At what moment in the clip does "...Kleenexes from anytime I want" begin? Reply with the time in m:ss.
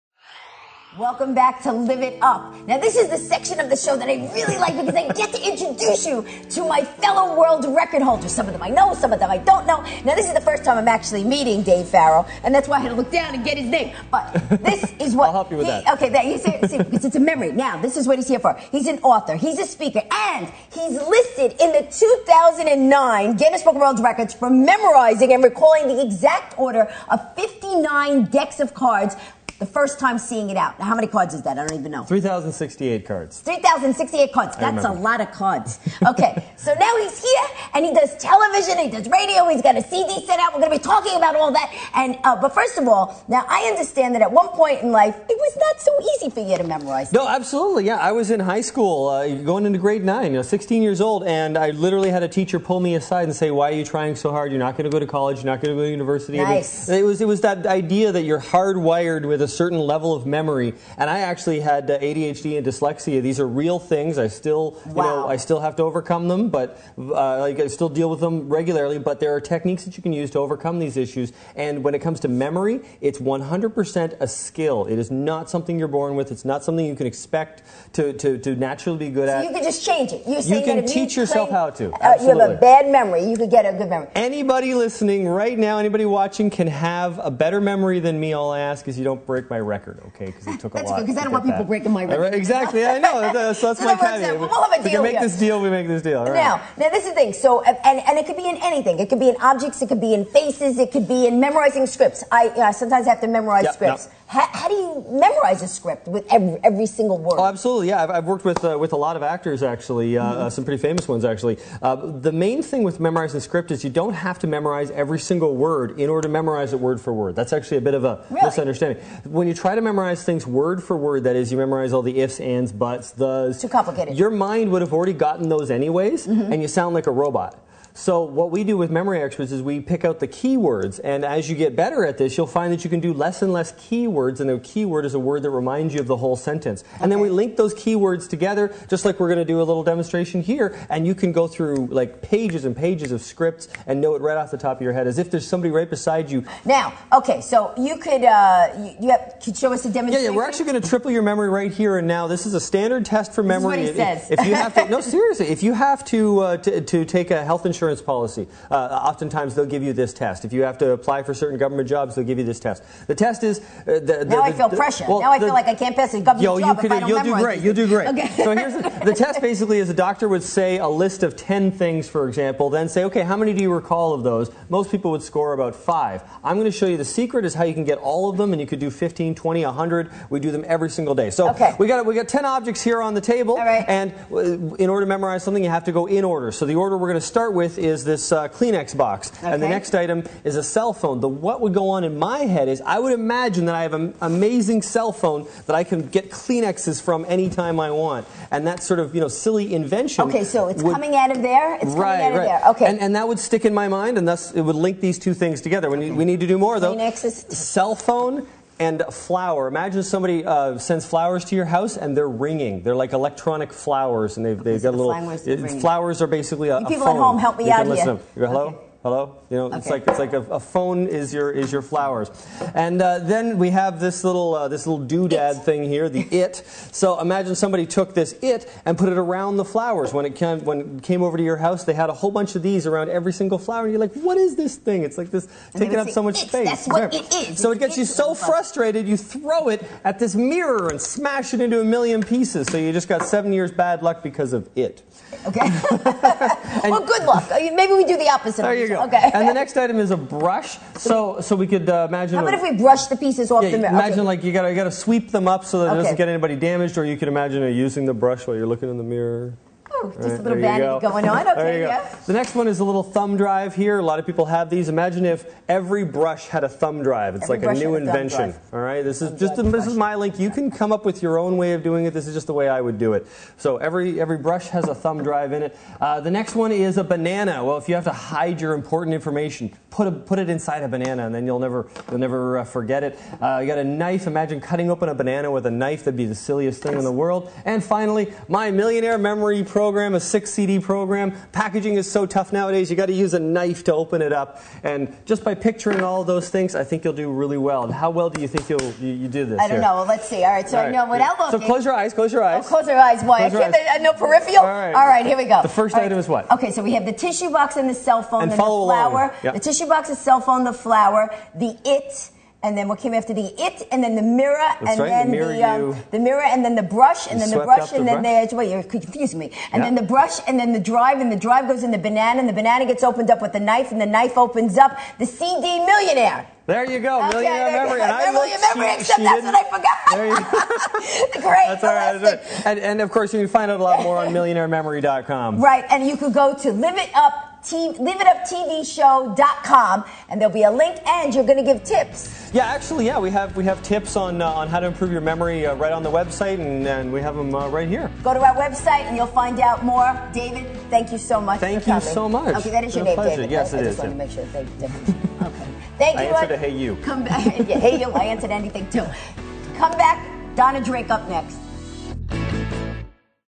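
3:16.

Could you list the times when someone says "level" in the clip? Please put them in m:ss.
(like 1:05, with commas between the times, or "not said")
0:59.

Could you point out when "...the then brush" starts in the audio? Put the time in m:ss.
5:18.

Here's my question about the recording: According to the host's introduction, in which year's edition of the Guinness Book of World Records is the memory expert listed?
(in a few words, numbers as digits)
2009.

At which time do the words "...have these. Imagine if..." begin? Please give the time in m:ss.
4:24.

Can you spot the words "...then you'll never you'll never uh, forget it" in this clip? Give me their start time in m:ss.
4:41.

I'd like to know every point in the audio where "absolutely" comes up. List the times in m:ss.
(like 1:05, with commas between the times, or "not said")
0:47, 1:47.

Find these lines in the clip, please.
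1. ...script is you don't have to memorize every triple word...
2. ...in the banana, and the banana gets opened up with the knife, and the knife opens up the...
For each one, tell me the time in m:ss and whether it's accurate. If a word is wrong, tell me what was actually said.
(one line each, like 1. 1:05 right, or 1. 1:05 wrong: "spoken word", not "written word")
1. 1:53 wrong: "single", not "triple"
2. 5:21 right.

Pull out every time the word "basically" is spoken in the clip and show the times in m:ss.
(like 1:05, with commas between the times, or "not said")
2:49, 3:36.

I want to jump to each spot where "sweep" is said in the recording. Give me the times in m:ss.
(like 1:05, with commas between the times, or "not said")
4:14.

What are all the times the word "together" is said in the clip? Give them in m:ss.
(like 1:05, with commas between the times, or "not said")
2:18, 3:25.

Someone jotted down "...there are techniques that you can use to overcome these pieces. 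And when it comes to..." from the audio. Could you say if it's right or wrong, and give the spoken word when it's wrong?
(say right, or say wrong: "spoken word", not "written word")
wrong: "issues", not "pieces".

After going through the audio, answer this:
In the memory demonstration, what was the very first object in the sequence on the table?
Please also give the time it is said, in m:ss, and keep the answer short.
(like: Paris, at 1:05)
Kleenex box, at 3:08.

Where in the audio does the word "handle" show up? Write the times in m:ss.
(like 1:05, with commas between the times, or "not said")
not said.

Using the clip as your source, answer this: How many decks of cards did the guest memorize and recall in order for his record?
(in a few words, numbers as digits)
59.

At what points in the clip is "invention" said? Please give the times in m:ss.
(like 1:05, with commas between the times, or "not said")
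3:19, 4:27.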